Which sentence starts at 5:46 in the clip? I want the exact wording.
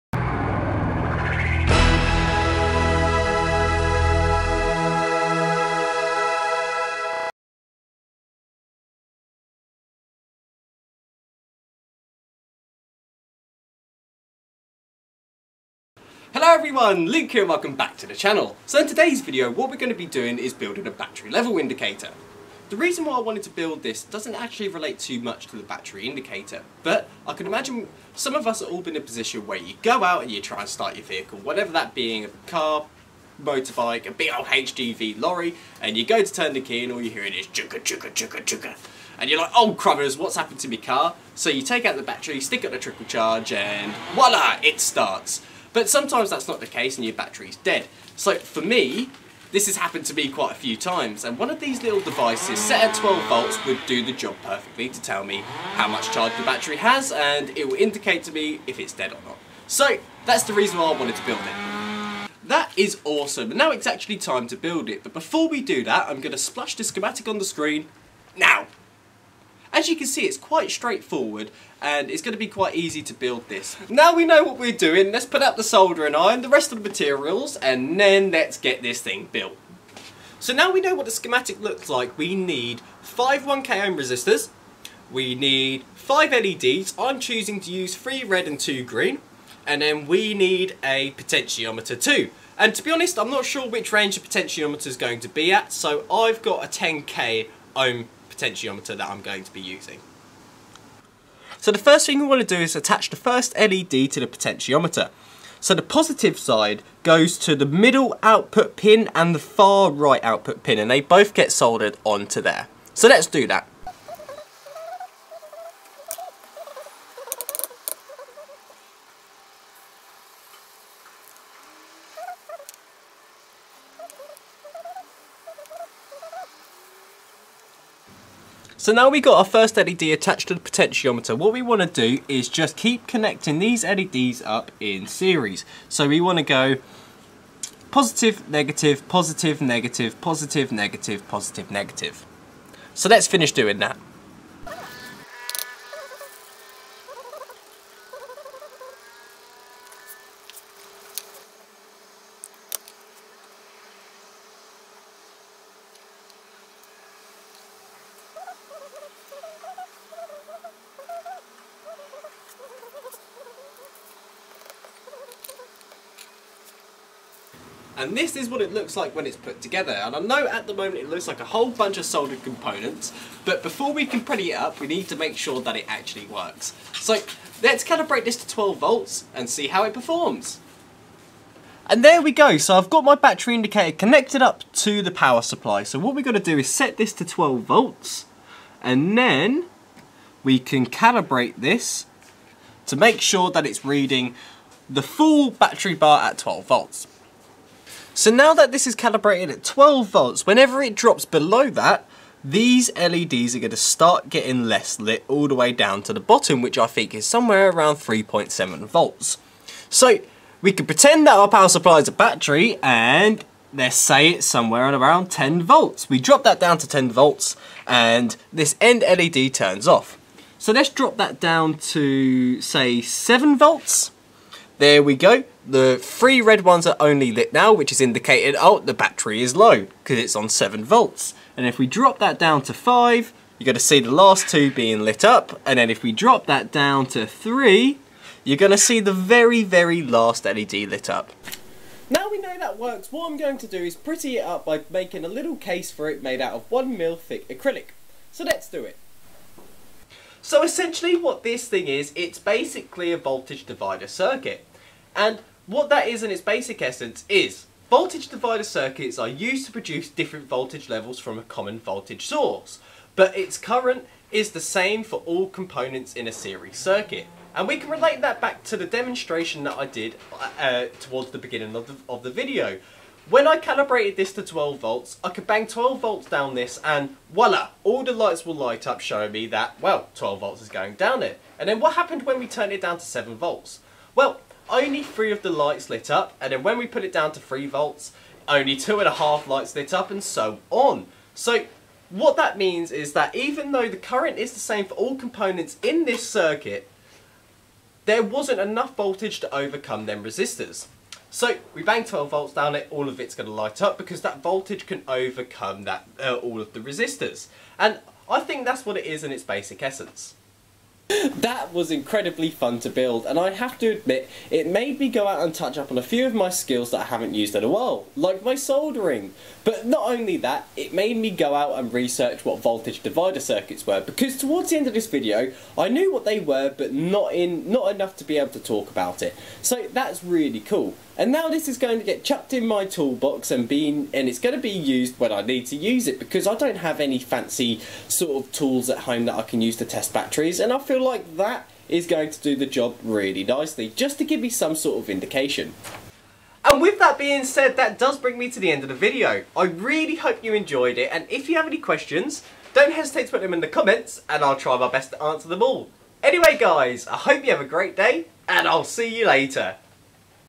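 And with that being said, that does bring me to the end of the video.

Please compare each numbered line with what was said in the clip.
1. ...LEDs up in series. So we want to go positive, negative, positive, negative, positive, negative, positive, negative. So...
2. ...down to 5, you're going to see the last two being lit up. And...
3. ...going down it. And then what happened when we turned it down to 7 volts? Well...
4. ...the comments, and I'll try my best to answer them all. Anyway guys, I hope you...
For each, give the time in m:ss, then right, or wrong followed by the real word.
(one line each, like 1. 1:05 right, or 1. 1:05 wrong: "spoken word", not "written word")
1. 2:13 right
2. 3:52 right
3. 4:40 right
4. 5:53 right.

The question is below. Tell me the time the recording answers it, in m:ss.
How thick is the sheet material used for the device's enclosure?
4:06.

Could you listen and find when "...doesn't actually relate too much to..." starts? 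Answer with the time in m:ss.
0:24.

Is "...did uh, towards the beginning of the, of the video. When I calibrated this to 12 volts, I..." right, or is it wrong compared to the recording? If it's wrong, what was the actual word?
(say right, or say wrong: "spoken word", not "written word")
right.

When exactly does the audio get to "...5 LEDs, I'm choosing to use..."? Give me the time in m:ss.
1:25.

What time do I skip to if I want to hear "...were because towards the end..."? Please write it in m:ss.
5:23.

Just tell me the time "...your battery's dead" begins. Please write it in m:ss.
0:47.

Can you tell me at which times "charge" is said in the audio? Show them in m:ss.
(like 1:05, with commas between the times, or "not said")
0:43, 0:56.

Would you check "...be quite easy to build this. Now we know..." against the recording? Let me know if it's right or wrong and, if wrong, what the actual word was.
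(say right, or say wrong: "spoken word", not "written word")
right.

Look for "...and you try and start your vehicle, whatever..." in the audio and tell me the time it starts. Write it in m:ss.
0:30.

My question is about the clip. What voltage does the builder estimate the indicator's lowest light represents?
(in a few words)
3.7 volts.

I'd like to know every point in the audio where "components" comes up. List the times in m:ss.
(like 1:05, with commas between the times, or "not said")
2:52, 4:25, 4:55.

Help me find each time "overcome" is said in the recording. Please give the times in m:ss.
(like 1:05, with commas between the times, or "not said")
4:59, 5:05.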